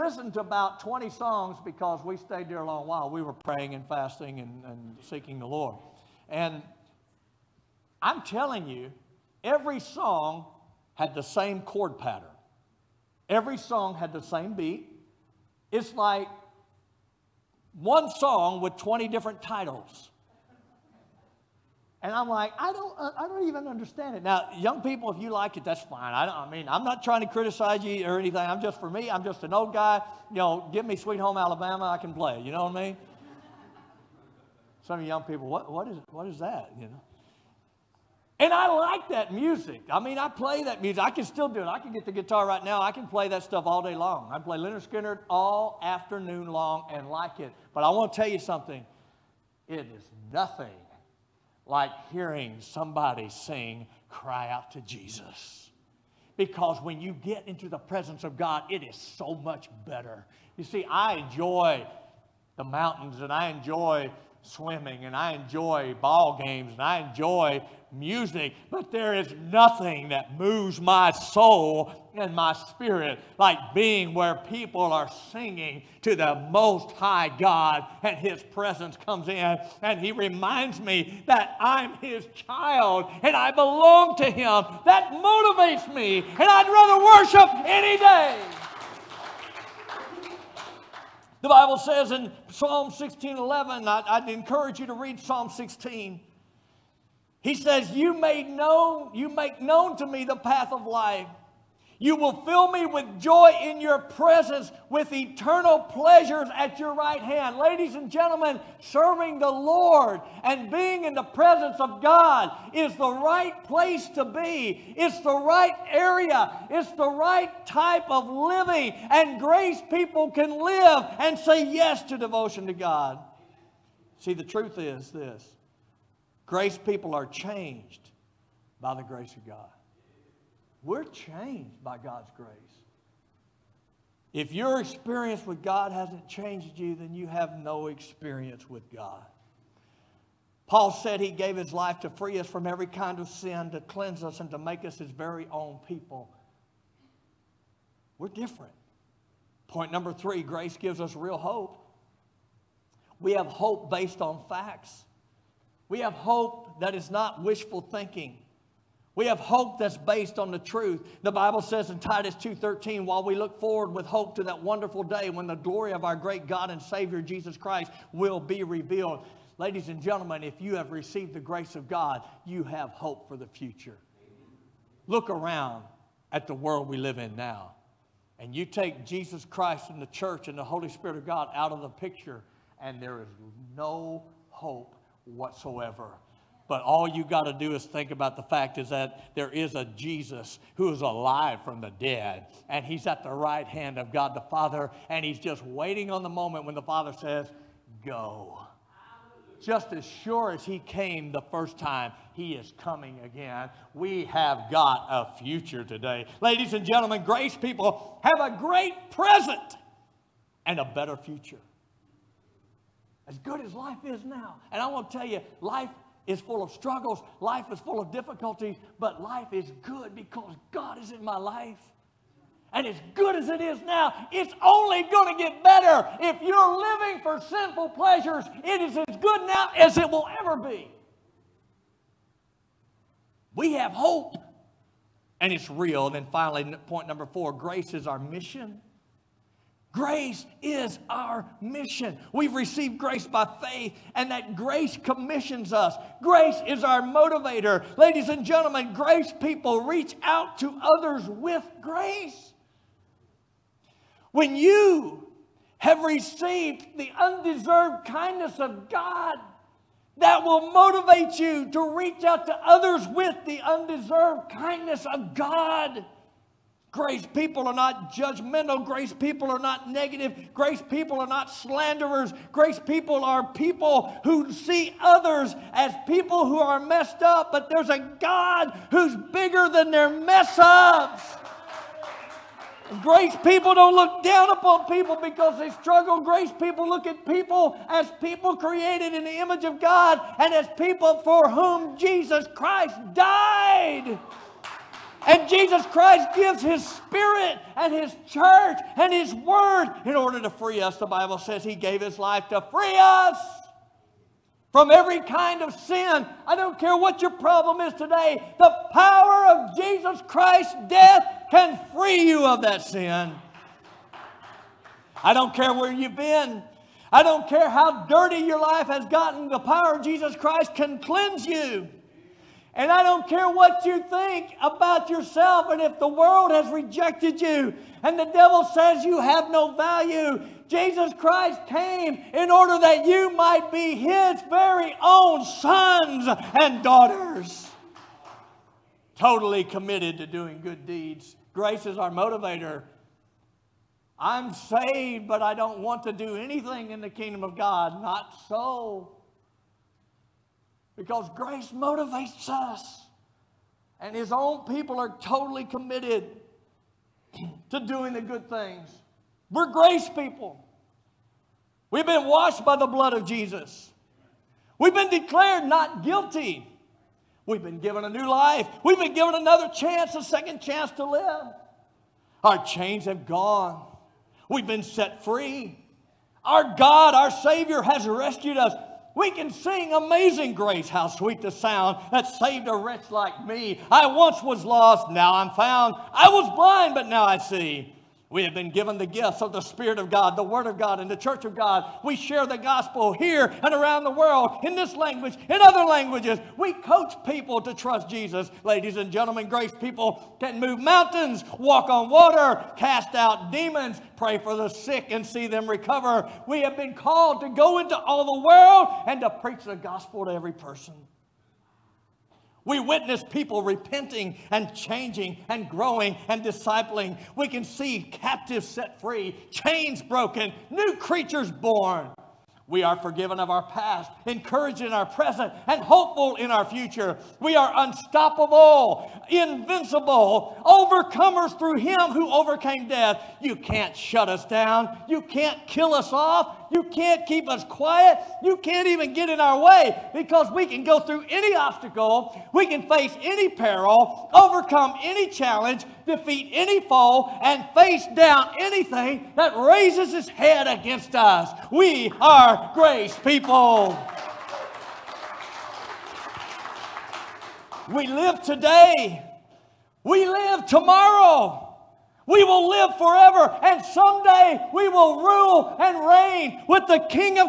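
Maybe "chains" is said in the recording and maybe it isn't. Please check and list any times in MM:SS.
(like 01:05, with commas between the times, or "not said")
06:12, 06:59.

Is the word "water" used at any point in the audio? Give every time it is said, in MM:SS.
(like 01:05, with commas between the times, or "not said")
06:42.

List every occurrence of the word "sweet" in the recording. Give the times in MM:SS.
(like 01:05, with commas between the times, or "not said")
00:30, 06:21.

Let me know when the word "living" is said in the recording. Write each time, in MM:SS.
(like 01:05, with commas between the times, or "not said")
01:58, 03:46.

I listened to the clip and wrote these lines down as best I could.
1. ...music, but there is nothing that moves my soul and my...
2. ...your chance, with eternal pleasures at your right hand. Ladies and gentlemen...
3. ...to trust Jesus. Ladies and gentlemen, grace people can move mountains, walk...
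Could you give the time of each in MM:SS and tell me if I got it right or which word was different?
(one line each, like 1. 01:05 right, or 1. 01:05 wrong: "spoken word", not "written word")
1. 01:07 right
2. 01:43 wrong: "presence", not "chance"
3. 06:37 right.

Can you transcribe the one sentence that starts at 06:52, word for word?
We witness people repenting and changing and growing and discipling.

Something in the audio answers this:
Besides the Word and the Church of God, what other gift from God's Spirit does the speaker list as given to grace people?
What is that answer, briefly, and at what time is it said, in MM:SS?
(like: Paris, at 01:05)
gifts of the Spirit, at 06:29.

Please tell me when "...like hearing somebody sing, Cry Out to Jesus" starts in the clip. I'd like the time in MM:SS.
00:51.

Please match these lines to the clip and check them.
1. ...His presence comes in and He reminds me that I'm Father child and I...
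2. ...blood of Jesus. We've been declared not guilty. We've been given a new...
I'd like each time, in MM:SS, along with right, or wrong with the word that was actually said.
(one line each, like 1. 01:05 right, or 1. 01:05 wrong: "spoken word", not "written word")
1. 01:18 wrong: "His", not "Father"
2. 06:02 right.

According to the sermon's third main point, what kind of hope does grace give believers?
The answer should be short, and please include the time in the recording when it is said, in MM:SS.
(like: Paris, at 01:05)
real hope, at 02:31.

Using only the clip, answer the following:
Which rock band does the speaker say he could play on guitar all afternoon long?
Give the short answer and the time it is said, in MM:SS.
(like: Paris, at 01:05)
Lynyrd Skynyrd, at 00:44.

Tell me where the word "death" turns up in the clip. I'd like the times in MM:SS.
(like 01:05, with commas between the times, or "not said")
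05:10, 07:12.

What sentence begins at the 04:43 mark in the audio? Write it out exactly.
Grace people don't look down upon people because they struggle.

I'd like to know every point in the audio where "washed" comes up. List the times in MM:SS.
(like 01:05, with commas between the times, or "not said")
06:02.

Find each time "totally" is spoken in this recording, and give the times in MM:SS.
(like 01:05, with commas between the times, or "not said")
05:39, 05:55.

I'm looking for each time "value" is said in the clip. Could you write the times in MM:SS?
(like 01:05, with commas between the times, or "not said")
05:29.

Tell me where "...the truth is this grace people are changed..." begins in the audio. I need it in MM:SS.
02:04.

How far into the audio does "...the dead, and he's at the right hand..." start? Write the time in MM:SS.
03:11.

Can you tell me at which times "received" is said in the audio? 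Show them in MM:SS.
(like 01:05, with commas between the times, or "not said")
02:50, 04:02, 04:16.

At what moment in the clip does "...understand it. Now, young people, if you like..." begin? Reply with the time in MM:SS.
00:23.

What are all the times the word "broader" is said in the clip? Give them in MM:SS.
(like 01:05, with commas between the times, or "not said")
not said.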